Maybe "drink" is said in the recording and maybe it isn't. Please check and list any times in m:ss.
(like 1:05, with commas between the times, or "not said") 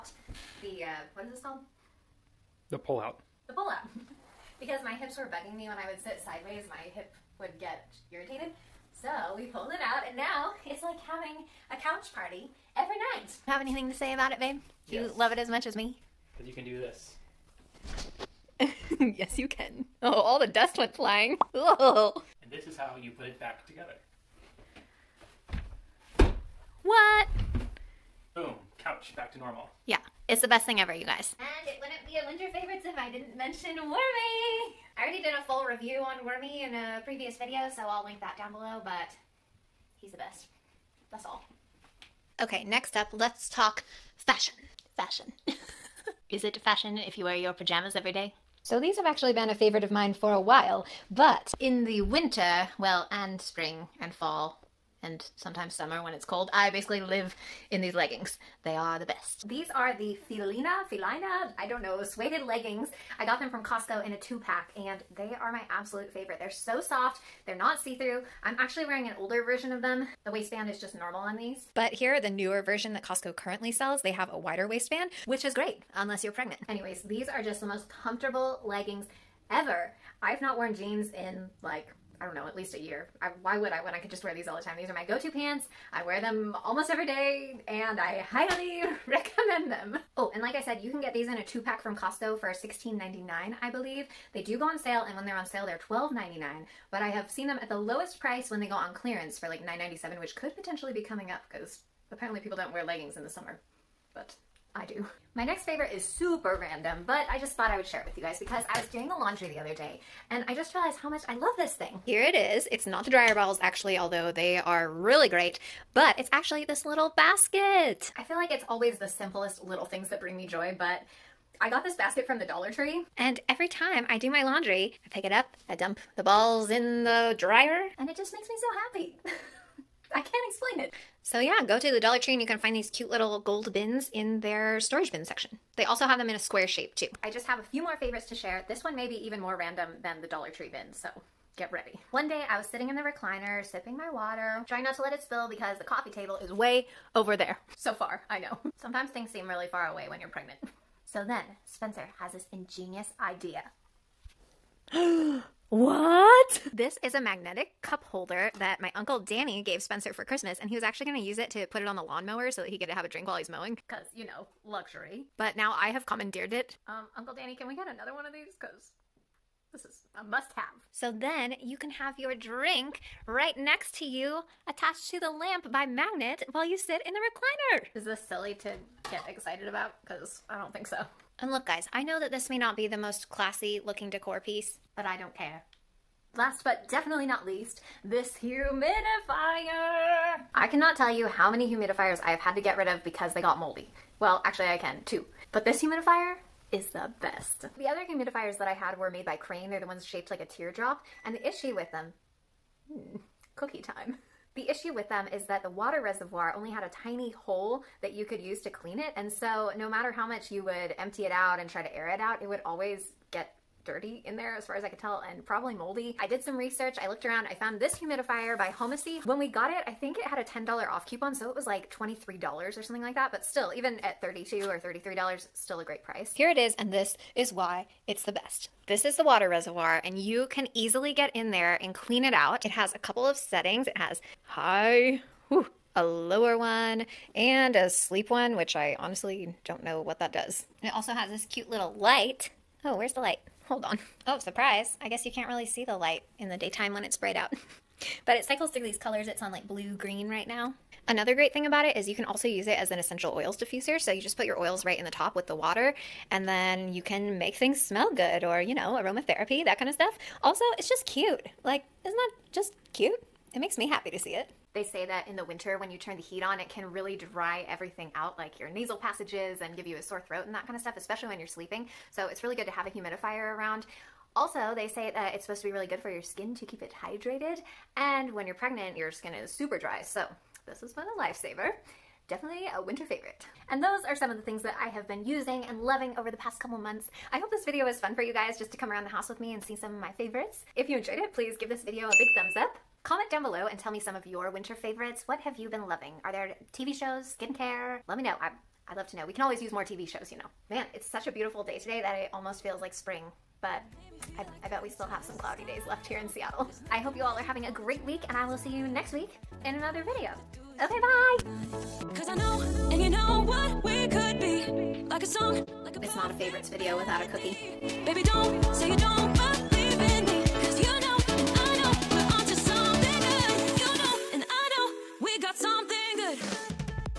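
2:43, 2:52.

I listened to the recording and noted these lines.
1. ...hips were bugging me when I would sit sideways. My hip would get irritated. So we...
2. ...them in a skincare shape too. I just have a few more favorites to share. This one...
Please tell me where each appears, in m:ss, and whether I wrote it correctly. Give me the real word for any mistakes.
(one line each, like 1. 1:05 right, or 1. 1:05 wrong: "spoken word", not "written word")
1. 0:04 right
2. 2:16 wrong: "square", not "skincare".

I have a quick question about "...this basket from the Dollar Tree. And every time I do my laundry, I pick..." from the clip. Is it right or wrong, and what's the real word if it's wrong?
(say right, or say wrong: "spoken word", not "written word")
right.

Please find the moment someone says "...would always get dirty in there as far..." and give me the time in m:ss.
3:32.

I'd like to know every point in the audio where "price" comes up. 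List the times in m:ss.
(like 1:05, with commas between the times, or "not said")
1:38, 3:46.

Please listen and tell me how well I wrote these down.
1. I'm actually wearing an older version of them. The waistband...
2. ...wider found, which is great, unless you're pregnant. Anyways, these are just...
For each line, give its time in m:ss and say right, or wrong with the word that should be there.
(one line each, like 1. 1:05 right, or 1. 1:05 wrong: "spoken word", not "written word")
1. 1:08 right
2. 1:14 wrong: "waistband", not "found".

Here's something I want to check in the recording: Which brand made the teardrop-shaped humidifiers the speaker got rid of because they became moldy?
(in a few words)
Crane.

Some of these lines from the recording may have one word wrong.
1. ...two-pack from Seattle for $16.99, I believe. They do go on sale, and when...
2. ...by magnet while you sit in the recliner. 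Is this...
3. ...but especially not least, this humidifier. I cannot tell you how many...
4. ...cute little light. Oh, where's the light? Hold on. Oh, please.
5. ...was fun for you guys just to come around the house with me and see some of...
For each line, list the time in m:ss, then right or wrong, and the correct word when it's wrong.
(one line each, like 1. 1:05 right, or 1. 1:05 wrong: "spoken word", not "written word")
1. 1:31 wrong: "Costco", not "Seattle"
2. 2:55 right
3. 3:06 wrong: "definitely", not "especially"
4. 4:01 wrong: "surprise", not "please"
5. 4:47 right.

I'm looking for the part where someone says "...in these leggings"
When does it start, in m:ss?
0:57.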